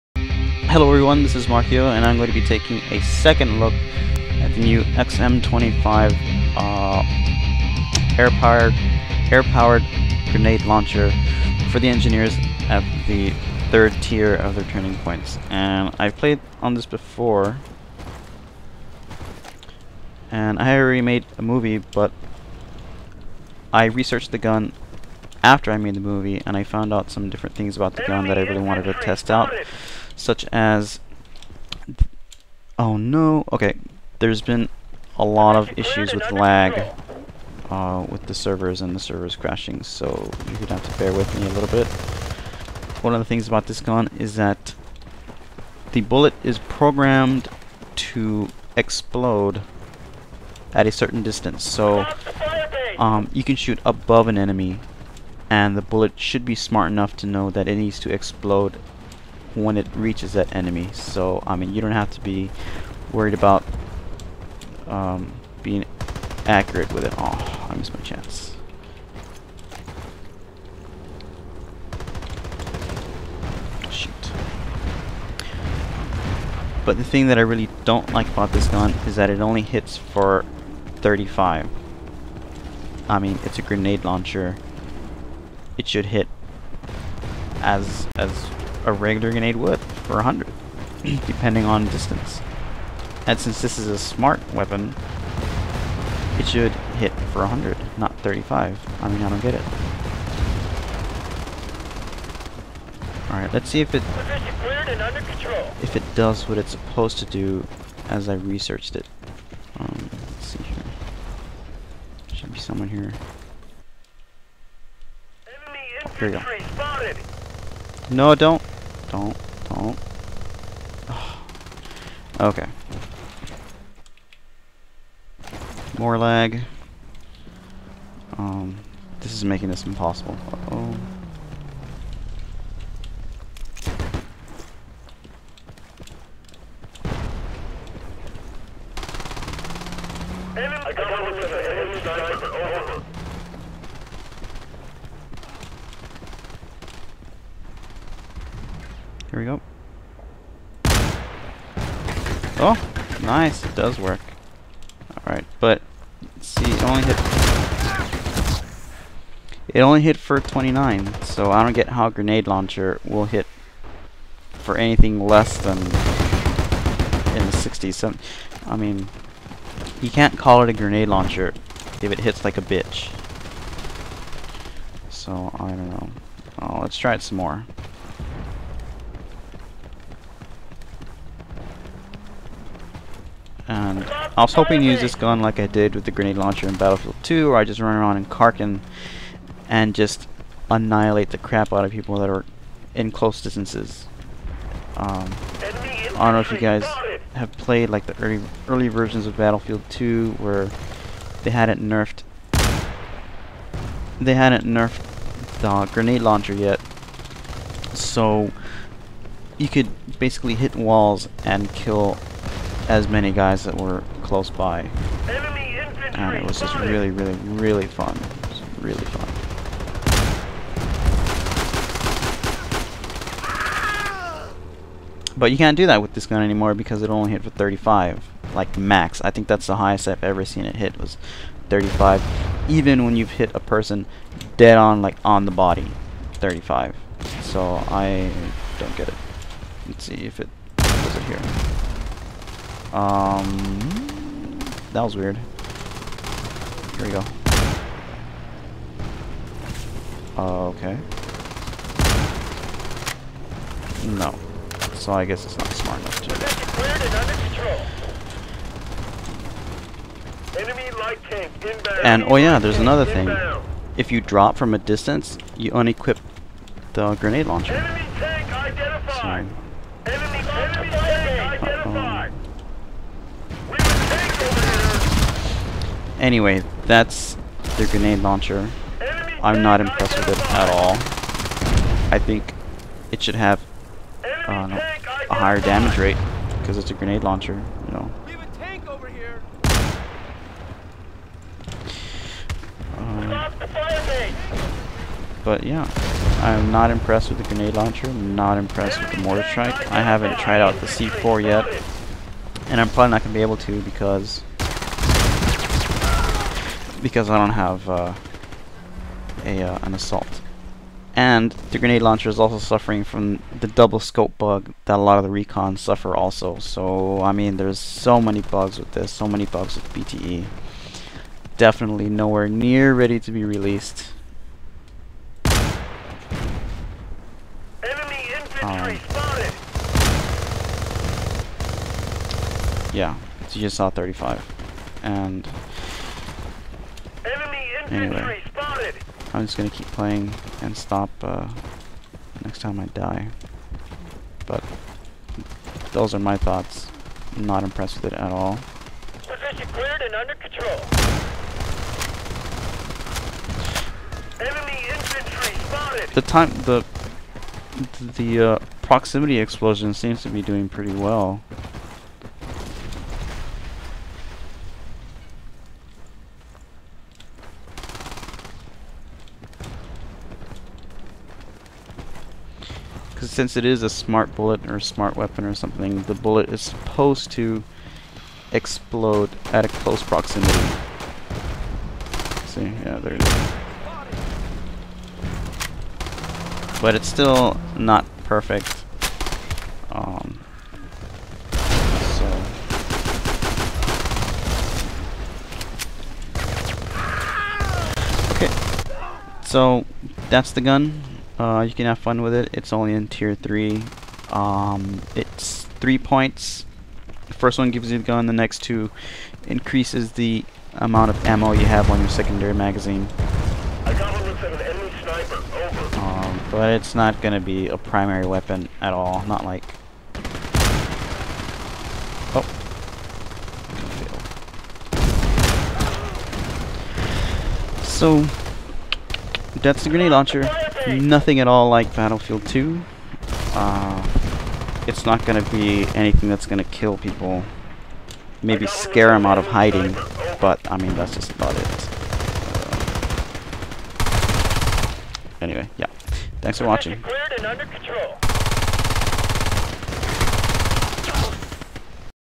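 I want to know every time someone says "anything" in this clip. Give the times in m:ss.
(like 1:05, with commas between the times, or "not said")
2:44, 7:15.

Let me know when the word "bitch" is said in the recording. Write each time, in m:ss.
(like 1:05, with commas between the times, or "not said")
2:52.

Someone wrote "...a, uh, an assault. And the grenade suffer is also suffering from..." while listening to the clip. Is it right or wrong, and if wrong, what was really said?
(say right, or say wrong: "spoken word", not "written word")
wrong: "launcher", not "suffer".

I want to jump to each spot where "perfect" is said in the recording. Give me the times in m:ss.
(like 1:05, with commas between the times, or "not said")
6:28.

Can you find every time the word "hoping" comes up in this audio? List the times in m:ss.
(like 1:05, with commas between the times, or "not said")
3:04.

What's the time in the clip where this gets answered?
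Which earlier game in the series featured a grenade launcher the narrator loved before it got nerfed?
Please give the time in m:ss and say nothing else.
3:06.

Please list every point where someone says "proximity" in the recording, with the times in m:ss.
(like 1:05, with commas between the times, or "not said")
5:58, 6:20.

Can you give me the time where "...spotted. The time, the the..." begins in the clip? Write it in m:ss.
5:55.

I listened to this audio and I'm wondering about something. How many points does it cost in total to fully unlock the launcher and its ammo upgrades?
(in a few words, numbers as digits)
3.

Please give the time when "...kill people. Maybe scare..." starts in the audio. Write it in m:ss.
7:16.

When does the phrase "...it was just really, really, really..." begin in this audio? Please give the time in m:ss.
3:36.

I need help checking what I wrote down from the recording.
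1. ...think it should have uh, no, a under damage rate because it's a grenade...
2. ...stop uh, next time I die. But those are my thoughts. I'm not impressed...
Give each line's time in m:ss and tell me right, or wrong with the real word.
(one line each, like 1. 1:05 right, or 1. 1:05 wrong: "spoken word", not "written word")
1. 4:42 wrong: "higher", not "under"
2. 5:40 right.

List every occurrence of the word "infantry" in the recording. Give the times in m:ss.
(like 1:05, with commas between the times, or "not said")
1:55, 5:28, 5:54.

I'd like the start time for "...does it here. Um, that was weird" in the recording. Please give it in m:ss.
4:00.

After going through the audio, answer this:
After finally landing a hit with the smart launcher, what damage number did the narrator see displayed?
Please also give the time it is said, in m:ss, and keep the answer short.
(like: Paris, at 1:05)
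29, at 2:40.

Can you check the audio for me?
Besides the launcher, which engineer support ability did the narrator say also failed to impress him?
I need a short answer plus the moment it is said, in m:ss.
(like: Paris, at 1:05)
mortar strike, at 4:59.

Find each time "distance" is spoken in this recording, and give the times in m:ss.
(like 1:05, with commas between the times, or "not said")
0:51, 1:31, 3:13, 4:24.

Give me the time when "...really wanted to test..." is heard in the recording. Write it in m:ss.
0:28.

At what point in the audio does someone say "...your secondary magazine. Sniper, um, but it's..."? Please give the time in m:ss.
6:51.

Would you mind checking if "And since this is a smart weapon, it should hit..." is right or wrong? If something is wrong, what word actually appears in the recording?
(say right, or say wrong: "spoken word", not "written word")
right.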